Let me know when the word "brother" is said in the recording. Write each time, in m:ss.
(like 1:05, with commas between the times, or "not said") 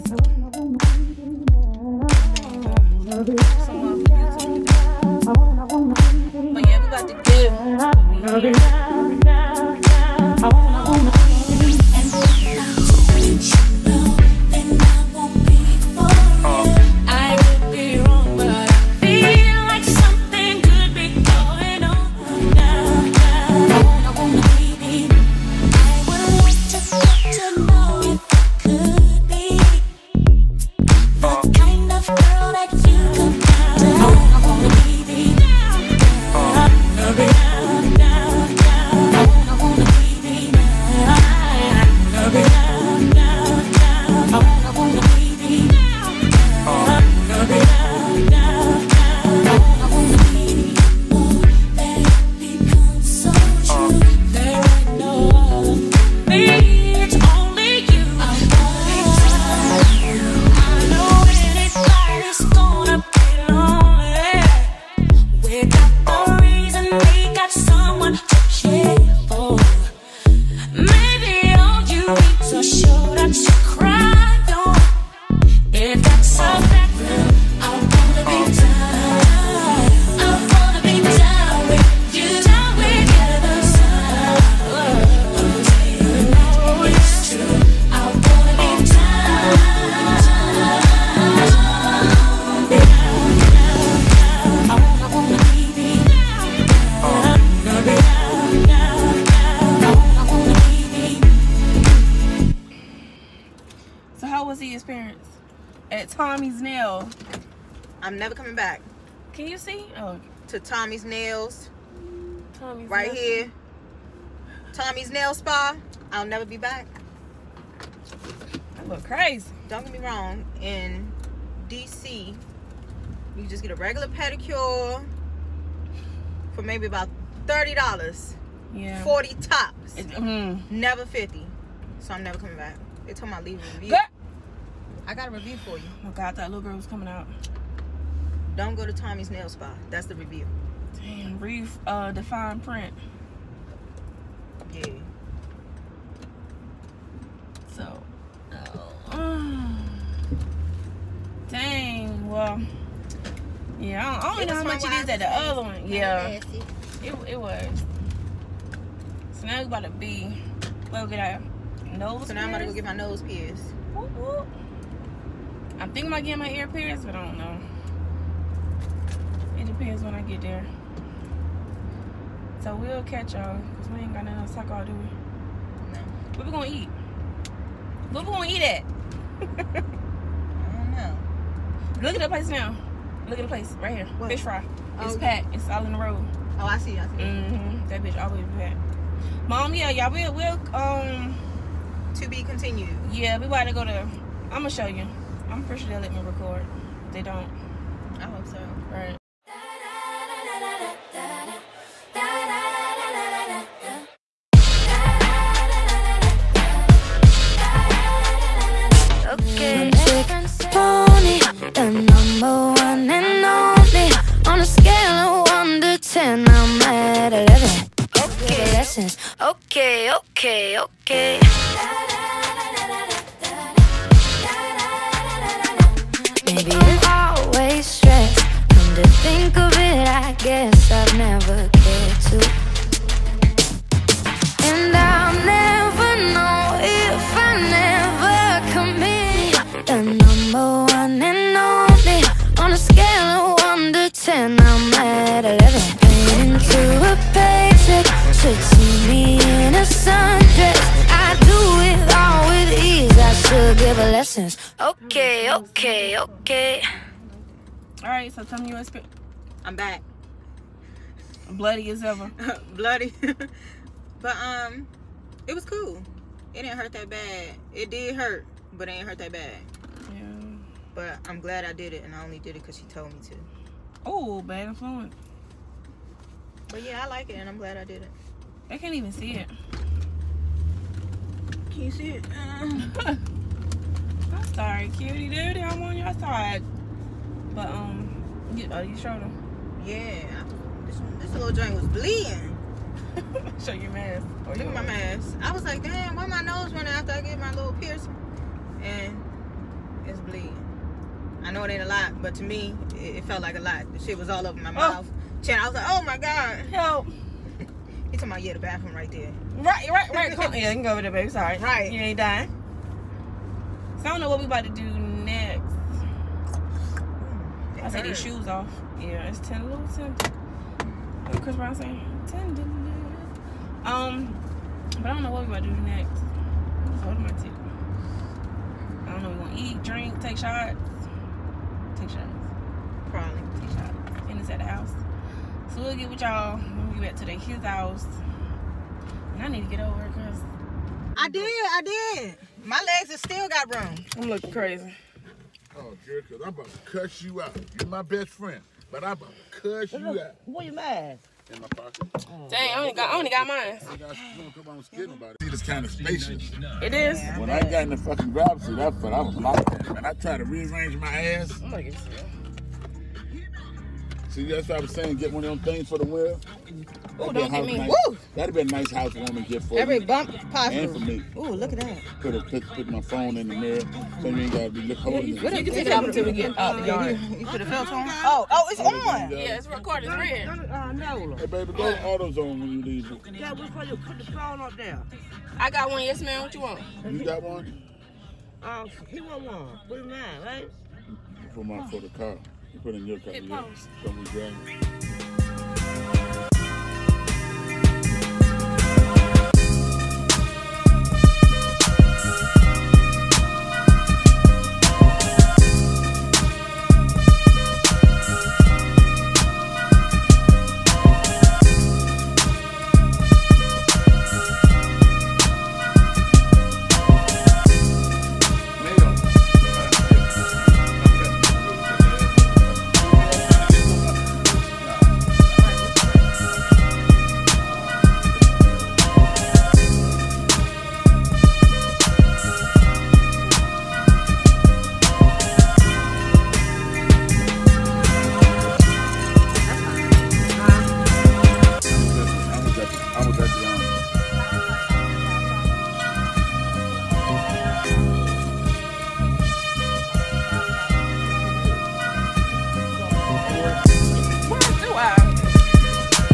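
not said.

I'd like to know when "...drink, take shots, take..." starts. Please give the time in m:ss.
5:29.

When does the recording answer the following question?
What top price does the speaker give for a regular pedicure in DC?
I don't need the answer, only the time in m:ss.
2:09.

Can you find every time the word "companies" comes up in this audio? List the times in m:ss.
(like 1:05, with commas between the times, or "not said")
not said.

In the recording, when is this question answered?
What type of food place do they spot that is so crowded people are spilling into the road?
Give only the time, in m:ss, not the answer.
3:04.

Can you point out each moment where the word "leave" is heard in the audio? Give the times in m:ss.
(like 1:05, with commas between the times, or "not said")
2:13, 6:22.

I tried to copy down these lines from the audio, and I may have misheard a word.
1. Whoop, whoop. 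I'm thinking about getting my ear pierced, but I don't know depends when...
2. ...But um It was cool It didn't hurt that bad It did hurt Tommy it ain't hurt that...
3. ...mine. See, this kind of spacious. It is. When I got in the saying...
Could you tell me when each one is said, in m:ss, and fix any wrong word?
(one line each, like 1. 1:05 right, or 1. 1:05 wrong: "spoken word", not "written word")
1. 2:43 right
2. 4:24 wrong: "But", not "Tommy"
3. 5:53 wrong: "fucking", not "saying".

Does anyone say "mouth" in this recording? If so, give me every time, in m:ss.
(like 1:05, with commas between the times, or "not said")
5:04.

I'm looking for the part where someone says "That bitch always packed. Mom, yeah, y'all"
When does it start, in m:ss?
3:07.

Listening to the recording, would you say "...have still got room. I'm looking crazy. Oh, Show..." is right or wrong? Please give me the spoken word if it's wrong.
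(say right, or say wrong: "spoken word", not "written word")
wrong: "Jericho", not "Show".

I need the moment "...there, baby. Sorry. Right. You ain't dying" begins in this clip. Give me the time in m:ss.
5:11.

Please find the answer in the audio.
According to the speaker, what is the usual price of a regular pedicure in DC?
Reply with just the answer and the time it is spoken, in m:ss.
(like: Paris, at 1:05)
$30, at 2:07.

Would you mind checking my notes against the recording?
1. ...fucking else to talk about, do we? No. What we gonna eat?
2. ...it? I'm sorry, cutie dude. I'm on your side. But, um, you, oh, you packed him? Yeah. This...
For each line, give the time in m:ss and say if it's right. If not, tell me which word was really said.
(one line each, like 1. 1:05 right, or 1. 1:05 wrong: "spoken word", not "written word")
1. 2:54 wrong: "nothing", not "fucking"
2. 4:42 wrong: "showed", not "packed".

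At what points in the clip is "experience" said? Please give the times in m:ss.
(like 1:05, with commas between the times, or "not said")
4:18.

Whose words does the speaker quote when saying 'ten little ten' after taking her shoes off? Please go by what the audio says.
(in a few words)
Chris Brown.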